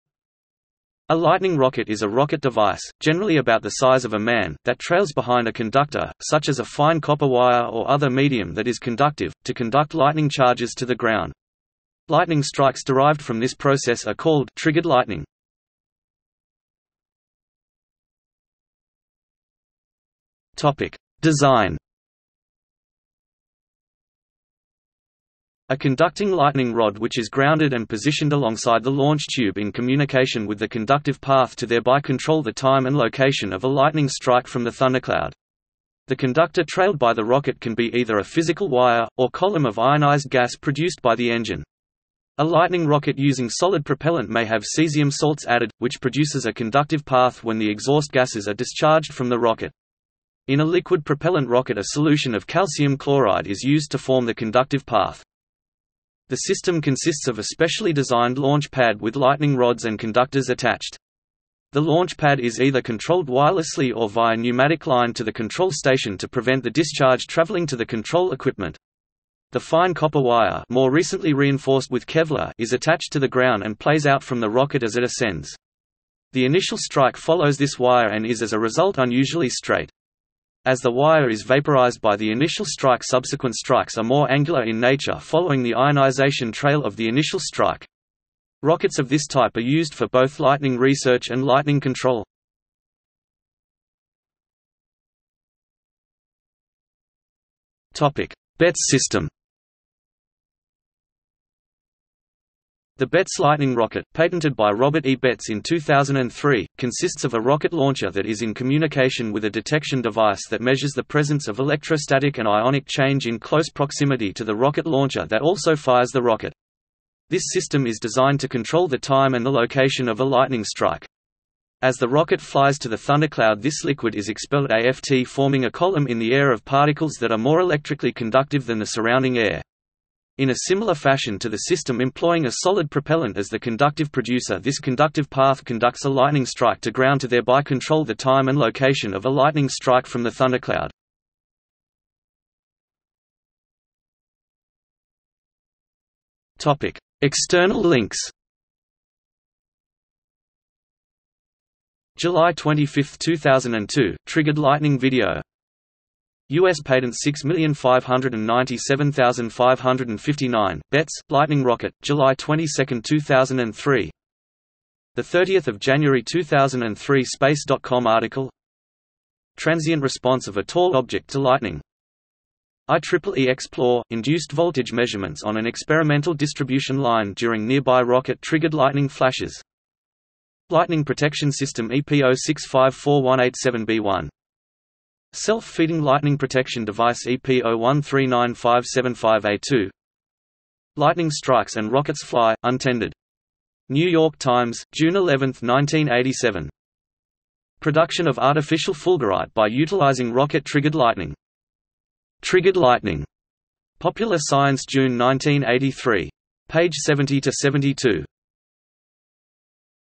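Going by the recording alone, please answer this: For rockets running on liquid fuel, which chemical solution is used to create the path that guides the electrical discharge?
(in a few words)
calcium chloride.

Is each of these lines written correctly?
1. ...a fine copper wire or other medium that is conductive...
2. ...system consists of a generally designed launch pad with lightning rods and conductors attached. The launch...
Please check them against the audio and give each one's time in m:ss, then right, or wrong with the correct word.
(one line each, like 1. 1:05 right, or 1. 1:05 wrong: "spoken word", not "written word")
1. 0:06 right
2. 0:56 wrong: "specially", not "generally".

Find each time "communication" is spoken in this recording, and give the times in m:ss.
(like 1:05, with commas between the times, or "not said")
0:29, 1:48.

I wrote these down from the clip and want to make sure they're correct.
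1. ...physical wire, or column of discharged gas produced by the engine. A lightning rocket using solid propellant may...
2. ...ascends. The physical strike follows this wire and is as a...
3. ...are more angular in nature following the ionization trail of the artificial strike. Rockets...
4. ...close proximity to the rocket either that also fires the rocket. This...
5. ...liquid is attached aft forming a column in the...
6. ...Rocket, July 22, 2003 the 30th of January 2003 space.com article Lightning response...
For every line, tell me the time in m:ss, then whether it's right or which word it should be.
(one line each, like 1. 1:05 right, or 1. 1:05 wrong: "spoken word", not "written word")
1. 0:38 wrong: "ionized", not "discharged"
2. 1:15 wrong: "initial", not "physical"
3. 1:23 wrong: "initial", not "artificial"
4. 1:53 wrong: "launcher", not "either"
5. 2:03 wrong: "expelled", not "attached"
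6. 2:41 wrong: "Transient", not "Lightning".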